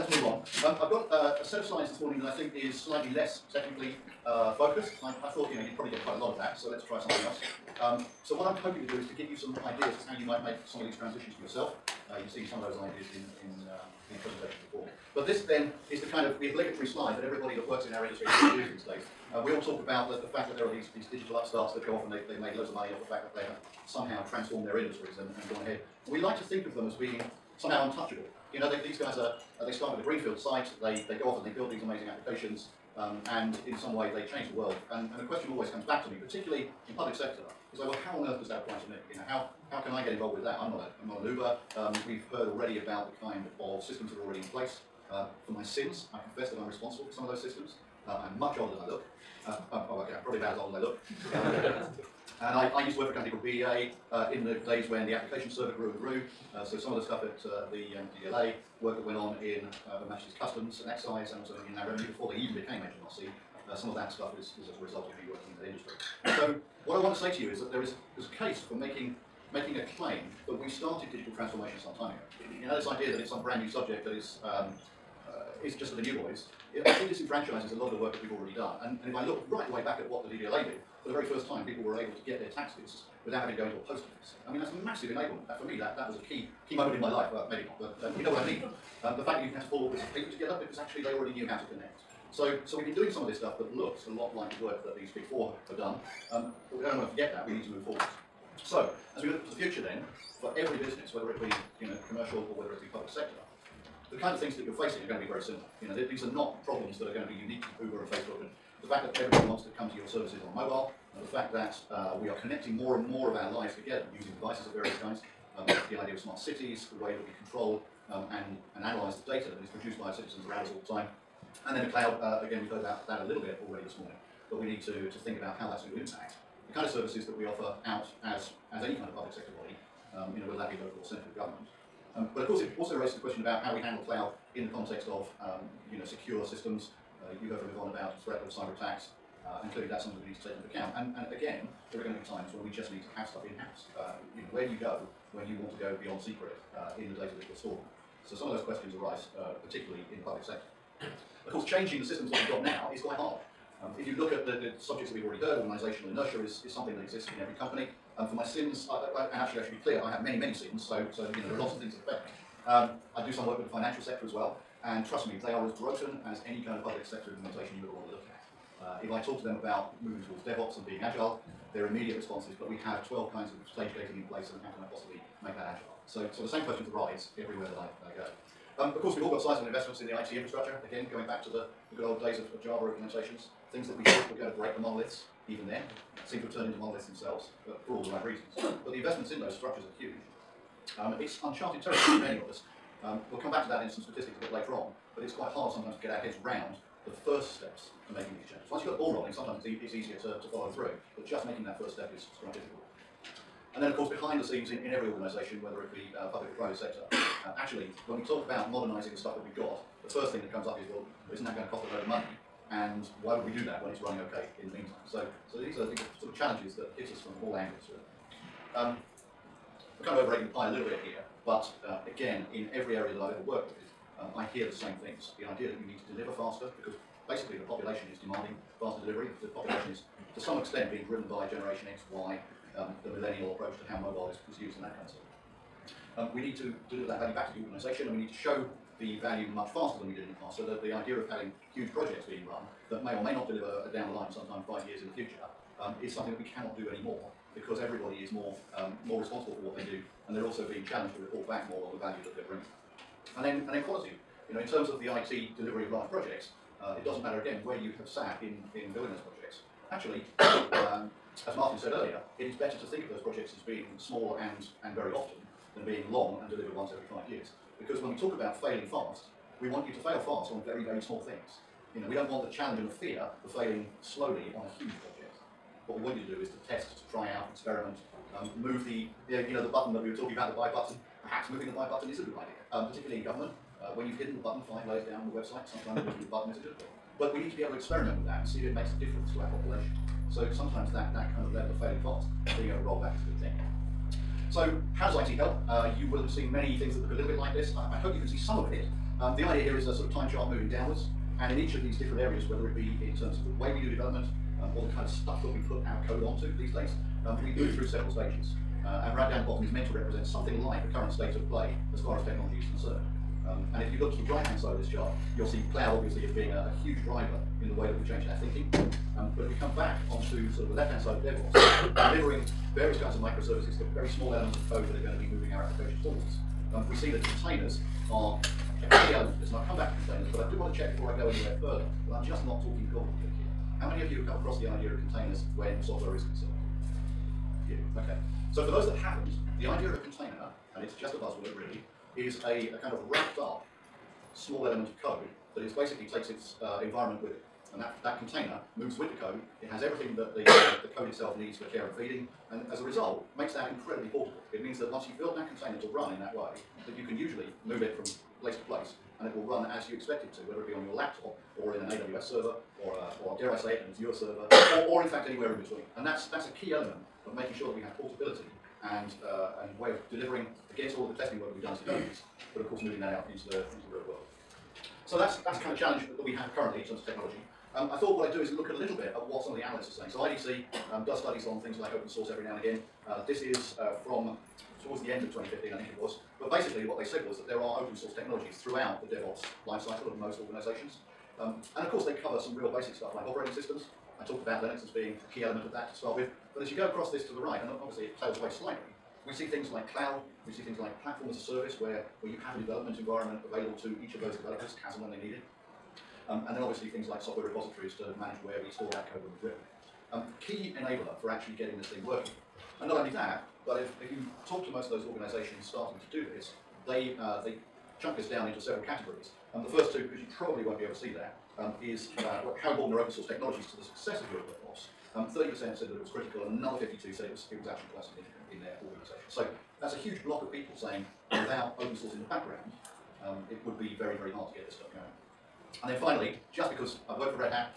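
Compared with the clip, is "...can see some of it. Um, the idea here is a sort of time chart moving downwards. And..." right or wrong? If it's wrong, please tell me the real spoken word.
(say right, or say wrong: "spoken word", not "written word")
right.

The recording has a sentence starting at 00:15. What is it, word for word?
But this then is the kind of the obligatory slide that everybody that works in our industry uses these days.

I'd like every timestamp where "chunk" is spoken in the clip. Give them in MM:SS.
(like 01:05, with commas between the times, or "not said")
06:57.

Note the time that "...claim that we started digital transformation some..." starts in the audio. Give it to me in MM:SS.
01:09.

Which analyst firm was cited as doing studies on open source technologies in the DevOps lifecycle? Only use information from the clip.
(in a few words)
IDC.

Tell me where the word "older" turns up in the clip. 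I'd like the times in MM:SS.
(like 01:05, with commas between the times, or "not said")
00:48.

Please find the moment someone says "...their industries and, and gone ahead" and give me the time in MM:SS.
00:24.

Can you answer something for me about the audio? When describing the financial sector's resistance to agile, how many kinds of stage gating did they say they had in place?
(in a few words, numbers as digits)
12.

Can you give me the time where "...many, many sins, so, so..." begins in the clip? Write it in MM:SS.
02:40.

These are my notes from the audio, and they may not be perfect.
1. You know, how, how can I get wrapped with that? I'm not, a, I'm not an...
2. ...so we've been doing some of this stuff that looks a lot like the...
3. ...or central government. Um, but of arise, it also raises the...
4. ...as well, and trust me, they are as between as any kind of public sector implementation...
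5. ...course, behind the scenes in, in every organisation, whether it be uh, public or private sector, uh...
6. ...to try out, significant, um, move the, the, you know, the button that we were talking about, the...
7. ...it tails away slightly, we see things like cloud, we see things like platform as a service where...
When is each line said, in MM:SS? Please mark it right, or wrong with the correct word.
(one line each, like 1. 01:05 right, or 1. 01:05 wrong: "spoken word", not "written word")
1. 00:39 wrong: "involved", not "wrapped"
2. 01:32 right
3. 02:11 wrong: "course", not "arise"
4. 02:44 wrong: "broken", not "between"
5. 03:23 right
6. 04:36 wrong: "experiment", not "significant"
7. 06:38 right.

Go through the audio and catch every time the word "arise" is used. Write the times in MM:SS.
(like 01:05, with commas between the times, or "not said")
02:29, 02:56.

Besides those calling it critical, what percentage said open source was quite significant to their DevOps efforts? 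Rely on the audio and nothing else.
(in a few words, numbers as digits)
52.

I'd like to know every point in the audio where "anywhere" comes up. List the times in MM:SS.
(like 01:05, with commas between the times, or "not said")
05:31, 06:05.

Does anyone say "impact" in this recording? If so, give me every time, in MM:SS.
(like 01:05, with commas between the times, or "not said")
02:06.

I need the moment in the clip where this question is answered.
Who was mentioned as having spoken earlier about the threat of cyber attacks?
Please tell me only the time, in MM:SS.
02:17.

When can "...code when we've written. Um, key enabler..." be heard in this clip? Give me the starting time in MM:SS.
06:49.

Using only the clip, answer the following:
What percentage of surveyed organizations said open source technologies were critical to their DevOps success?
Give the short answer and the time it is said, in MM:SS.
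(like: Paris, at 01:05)
30%, at 07:05.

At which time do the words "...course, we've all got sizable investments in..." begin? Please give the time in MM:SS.
02:59.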